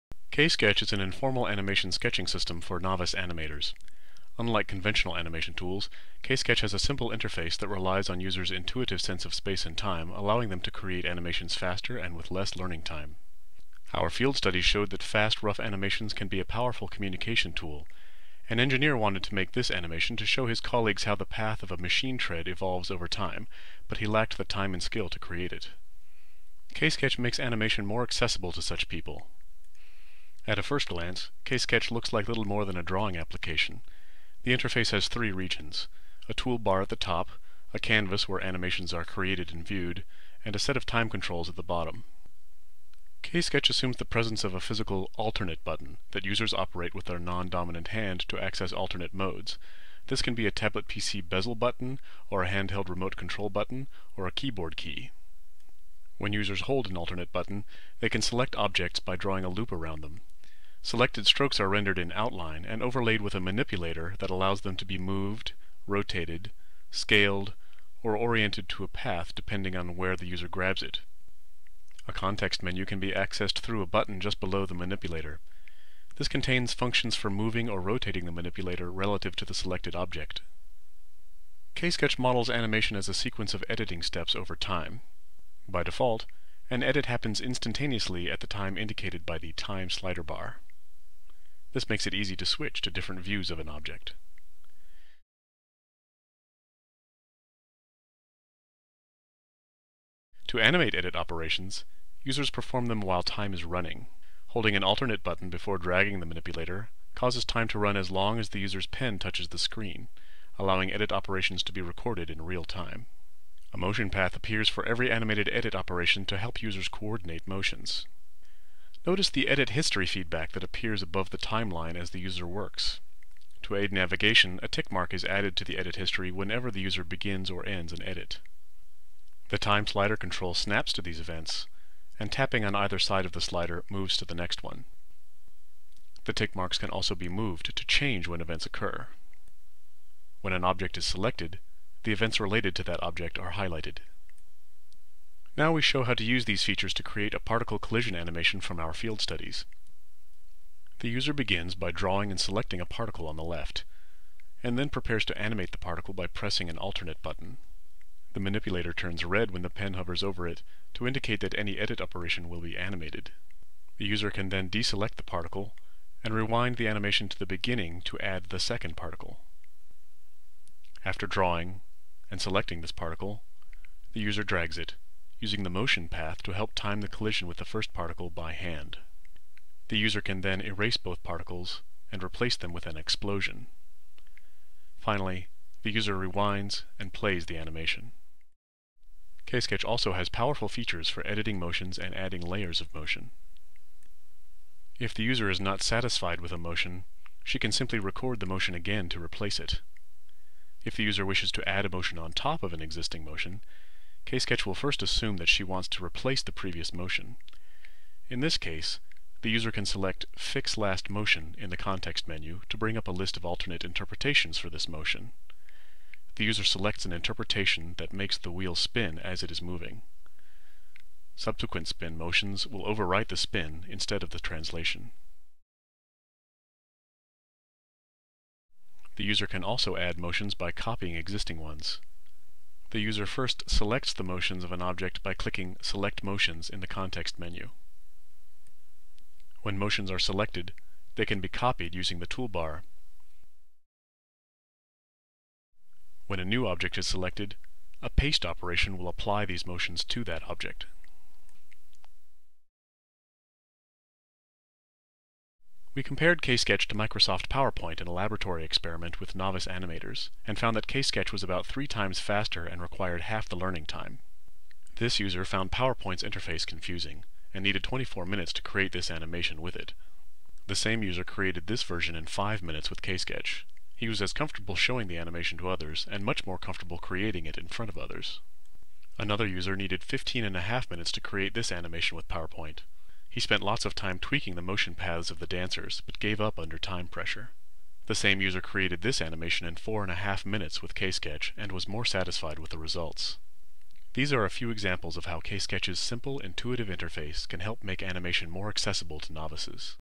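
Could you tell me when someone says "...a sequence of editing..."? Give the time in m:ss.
1:23.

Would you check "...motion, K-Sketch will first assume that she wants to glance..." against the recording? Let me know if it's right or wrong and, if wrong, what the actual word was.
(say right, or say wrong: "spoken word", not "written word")
wrong: "replace", not "glance".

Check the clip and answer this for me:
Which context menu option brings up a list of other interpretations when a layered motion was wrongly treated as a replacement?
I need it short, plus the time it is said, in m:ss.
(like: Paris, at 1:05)
Fix Last Motion, at 3:30.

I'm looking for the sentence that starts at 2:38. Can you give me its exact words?
The manipulator turns red when the pen hovers over it to indicate that any edit operation will be animated.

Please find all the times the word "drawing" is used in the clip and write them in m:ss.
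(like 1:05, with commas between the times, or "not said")
0:32, 0:59, 2:31, 2:51.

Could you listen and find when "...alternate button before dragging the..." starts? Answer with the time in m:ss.
1:44.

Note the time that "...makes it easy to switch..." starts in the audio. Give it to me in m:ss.
1:31.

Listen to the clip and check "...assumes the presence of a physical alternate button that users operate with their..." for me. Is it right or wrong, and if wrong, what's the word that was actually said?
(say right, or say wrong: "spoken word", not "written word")
right.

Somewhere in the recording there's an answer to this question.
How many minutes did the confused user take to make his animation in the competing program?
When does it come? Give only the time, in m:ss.
4:27.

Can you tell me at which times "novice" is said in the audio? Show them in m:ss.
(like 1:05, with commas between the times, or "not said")
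0:02, 4:19, 4:59.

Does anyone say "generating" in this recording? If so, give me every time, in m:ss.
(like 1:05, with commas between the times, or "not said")
not said.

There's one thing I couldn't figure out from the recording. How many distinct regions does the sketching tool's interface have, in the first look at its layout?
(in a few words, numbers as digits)
3.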